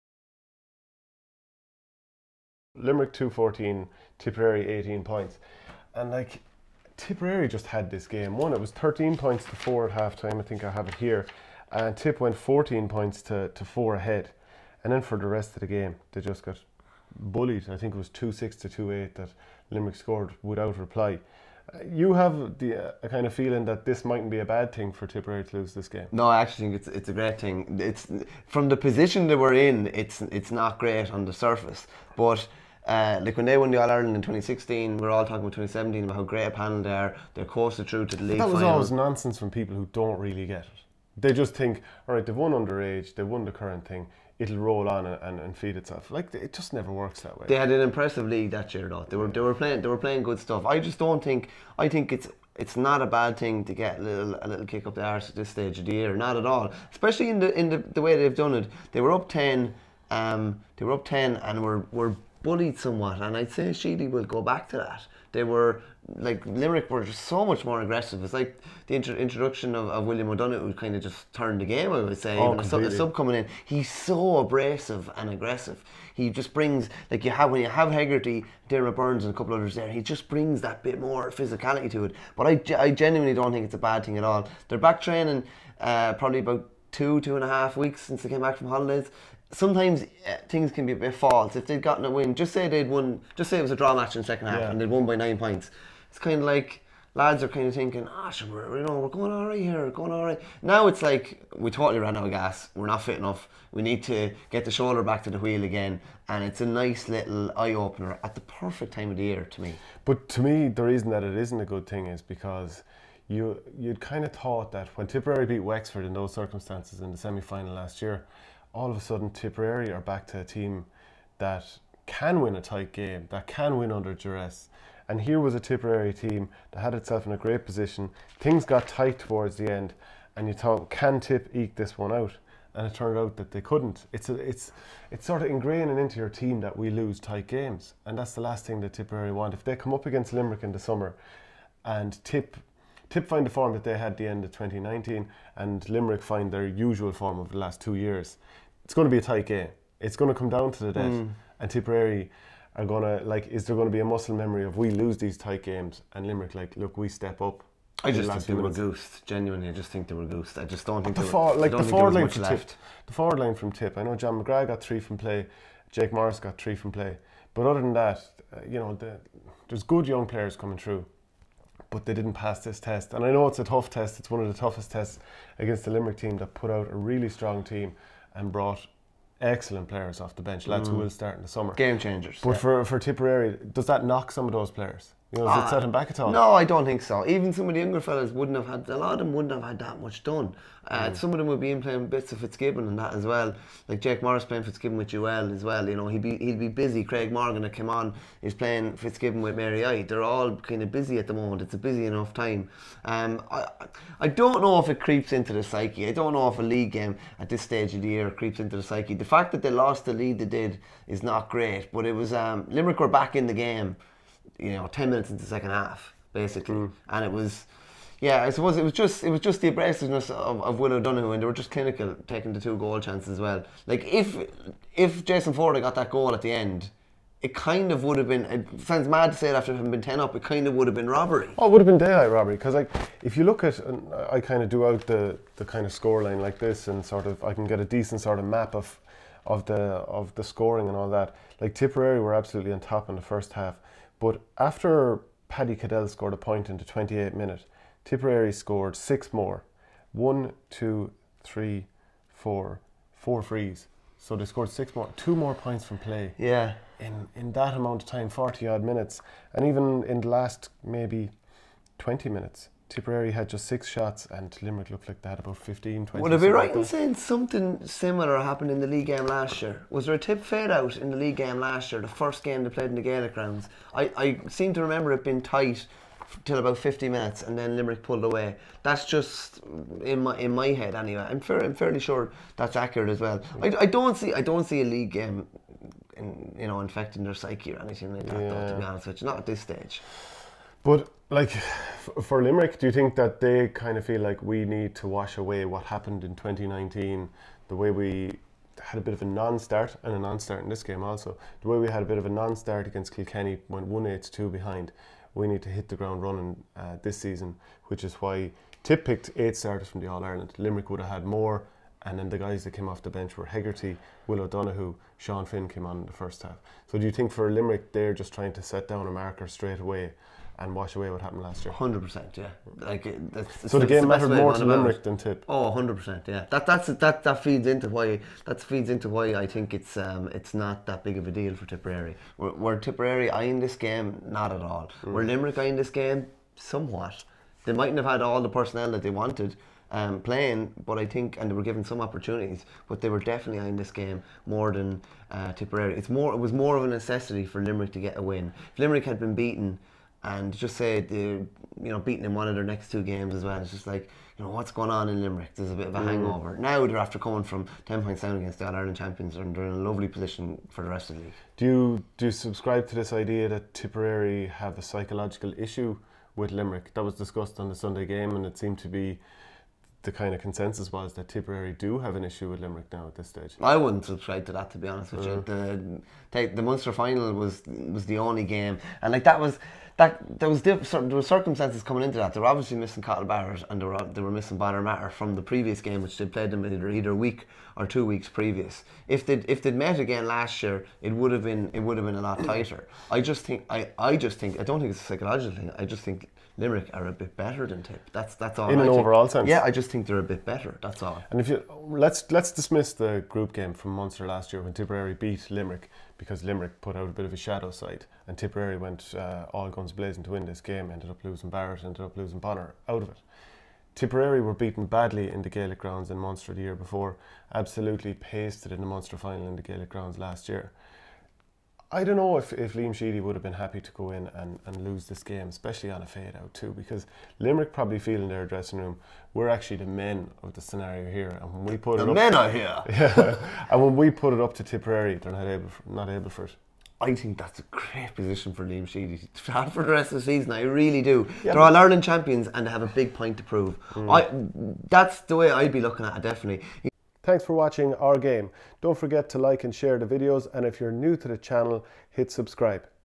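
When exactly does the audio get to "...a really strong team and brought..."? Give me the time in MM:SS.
02:56.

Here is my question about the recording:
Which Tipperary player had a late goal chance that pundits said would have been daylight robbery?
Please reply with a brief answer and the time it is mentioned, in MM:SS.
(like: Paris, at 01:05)
Jason Forde, at 03:45.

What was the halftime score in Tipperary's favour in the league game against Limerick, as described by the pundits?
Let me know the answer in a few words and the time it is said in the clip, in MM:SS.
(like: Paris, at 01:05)
13 points to 4, at 00:08.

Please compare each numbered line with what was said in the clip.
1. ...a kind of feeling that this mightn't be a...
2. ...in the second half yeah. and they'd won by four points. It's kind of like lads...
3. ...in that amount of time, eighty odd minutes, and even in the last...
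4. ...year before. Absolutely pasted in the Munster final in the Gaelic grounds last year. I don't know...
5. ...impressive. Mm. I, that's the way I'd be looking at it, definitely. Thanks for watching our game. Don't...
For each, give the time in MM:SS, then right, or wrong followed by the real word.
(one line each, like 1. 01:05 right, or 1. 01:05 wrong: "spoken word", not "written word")
1. 00:23 right
2. 01:34 wrong: "nine", not "four"
3. 04:17 wrong: "forty", not "eighty"
4. 06:56 right
5. 07:23 wrong: "prove", not "impressive".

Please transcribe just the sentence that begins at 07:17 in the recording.
I think that's a great position for Liam Sheedy to have for the rest of the season.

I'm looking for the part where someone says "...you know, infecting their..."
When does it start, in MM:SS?
04:46.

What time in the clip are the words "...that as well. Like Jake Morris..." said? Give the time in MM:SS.
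03:12.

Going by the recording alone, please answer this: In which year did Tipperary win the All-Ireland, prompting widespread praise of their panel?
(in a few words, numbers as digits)
2016.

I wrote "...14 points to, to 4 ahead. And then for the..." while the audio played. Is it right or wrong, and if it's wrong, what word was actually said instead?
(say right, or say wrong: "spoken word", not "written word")
right.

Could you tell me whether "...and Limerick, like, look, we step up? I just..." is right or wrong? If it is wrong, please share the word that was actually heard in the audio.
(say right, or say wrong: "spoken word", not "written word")
right.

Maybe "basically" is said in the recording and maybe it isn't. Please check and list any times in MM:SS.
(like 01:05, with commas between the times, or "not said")
03:36.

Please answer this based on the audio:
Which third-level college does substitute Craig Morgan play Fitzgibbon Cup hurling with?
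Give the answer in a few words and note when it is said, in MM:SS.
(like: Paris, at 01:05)
Mary I, at 03:19.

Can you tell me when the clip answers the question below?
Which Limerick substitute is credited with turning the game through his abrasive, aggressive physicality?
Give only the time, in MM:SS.
01:10.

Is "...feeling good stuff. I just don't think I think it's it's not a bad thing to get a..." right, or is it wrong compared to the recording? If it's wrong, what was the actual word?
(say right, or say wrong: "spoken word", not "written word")
wrong: "playing", not "feeling".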